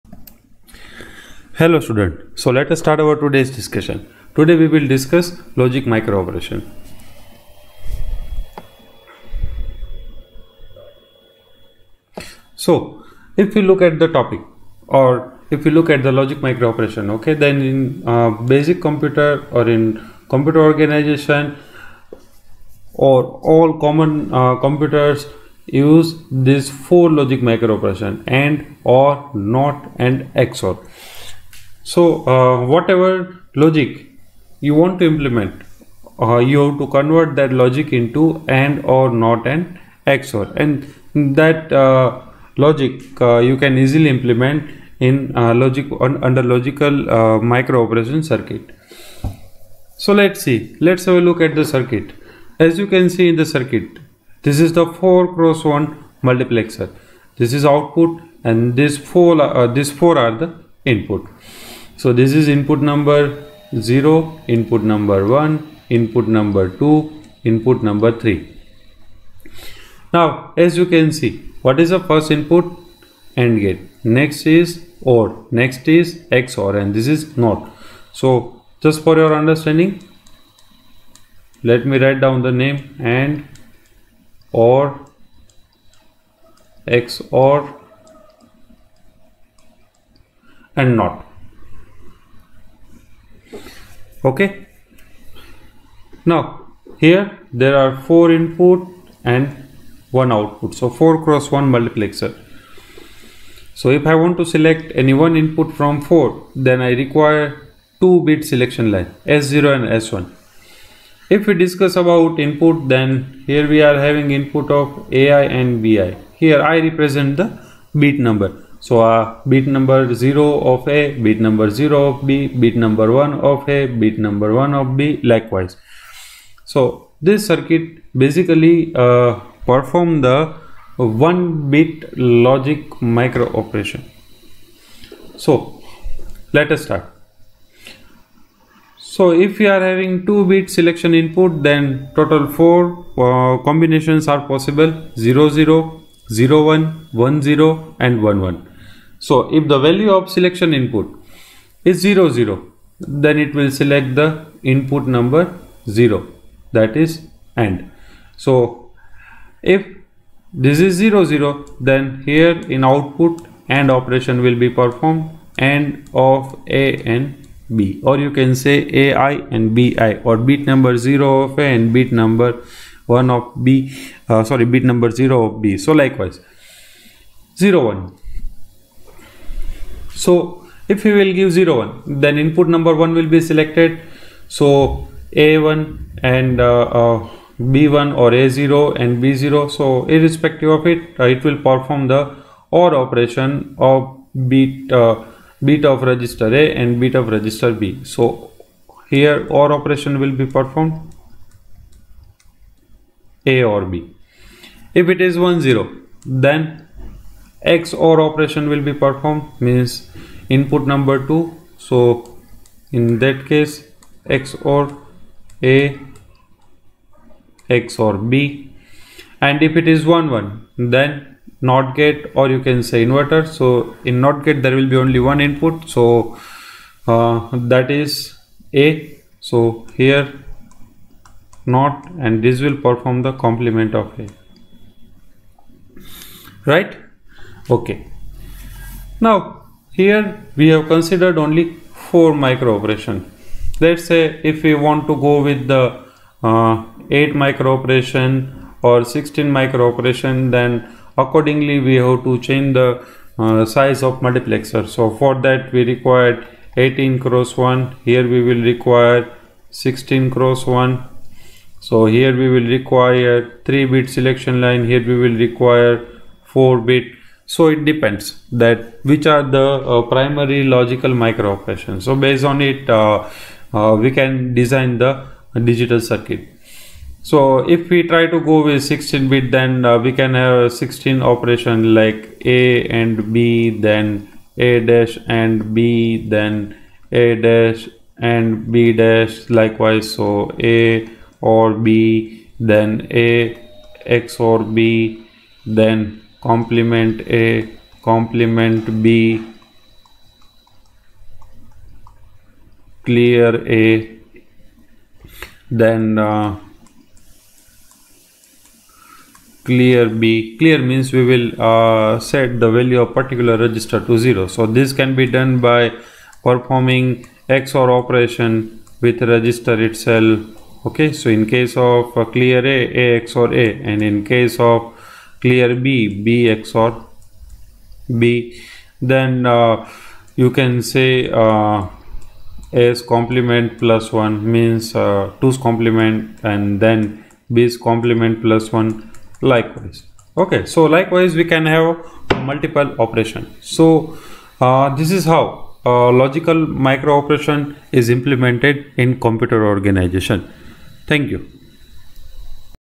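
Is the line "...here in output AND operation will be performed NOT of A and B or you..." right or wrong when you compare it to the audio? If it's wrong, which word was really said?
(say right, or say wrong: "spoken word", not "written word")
wrong: "AND", not "NOT".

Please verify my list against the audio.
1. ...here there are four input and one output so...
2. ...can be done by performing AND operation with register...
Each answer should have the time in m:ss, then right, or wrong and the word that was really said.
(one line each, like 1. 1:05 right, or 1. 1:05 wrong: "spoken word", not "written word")
1. 1:36 right
2. 5:14 wrong: "XOR", not "AND".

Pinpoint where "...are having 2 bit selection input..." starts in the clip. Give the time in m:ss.
2:19.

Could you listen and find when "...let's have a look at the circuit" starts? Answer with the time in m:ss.
0:50.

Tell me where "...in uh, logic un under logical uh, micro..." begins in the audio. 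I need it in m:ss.
0:44.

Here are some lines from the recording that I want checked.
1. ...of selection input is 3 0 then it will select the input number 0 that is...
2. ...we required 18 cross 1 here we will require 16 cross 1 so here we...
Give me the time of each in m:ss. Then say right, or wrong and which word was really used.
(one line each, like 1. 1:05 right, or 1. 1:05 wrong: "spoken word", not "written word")
1. 2:30 wrong: "0", not "3"
2. 4:15 right.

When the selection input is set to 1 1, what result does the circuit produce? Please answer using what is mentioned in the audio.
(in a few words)
Complement of A.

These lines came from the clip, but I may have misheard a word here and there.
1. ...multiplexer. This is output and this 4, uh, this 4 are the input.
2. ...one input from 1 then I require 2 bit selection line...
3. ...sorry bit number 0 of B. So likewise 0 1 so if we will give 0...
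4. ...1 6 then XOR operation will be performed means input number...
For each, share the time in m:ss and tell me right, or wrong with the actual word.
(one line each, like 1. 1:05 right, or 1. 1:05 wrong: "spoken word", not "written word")
1. 0:56 right
2. 1:45 wrong: "4", not "1"
3. 2:54 right
4. 3:25 wrong: "0", not "6".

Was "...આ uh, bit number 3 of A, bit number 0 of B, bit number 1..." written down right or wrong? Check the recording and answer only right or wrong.
wrong.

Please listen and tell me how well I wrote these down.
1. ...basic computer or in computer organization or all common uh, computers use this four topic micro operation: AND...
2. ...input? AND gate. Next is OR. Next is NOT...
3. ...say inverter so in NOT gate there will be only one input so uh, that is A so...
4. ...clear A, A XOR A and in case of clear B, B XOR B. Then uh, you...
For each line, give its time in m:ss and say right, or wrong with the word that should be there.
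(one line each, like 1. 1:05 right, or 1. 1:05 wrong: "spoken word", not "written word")
1. 0:18 wrong: "logic", not "topic"
2. 1:12 wrong: "XOR", not "NOT"
3. 3:42 right
4. 5:22 right.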